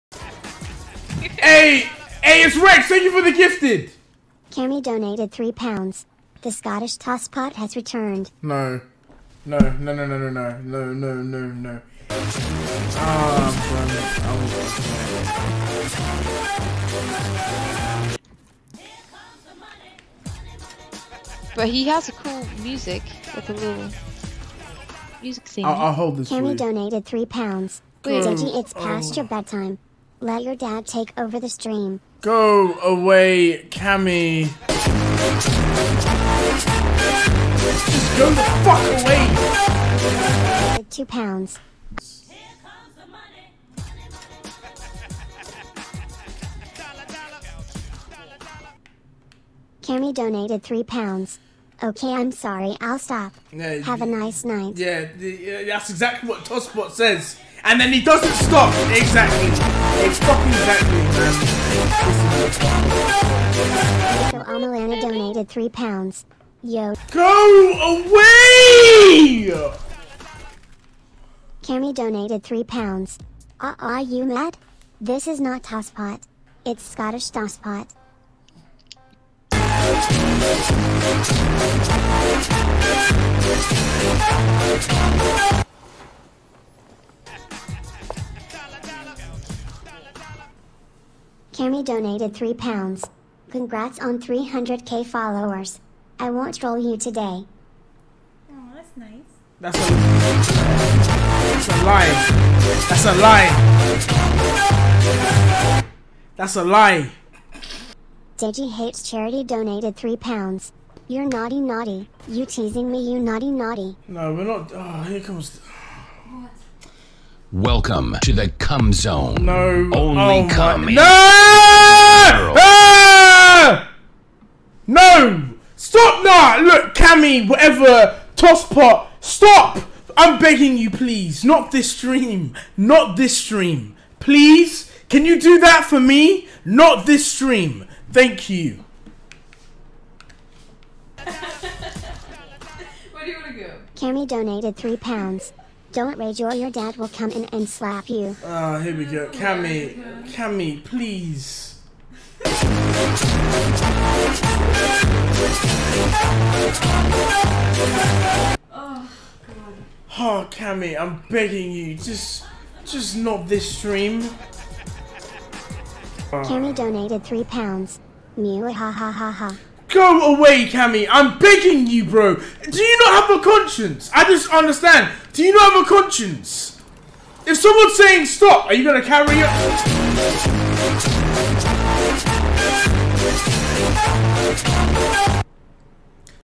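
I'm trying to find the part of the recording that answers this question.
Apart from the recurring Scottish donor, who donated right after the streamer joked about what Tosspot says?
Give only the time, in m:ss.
1:04.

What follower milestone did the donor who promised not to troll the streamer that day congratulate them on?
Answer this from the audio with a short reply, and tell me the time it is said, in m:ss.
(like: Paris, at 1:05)
300k, at 1:34.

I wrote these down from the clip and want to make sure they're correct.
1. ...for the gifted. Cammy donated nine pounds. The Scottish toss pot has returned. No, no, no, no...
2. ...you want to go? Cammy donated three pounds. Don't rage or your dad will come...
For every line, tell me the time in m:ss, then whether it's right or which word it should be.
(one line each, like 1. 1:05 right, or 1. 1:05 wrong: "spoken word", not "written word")
1. 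0:03 wrong: "three", not "nine"
2. 2:23 right.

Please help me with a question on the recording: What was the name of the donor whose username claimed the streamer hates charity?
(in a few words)
Deji Hates Charity.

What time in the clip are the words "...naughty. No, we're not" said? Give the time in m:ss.
1:53.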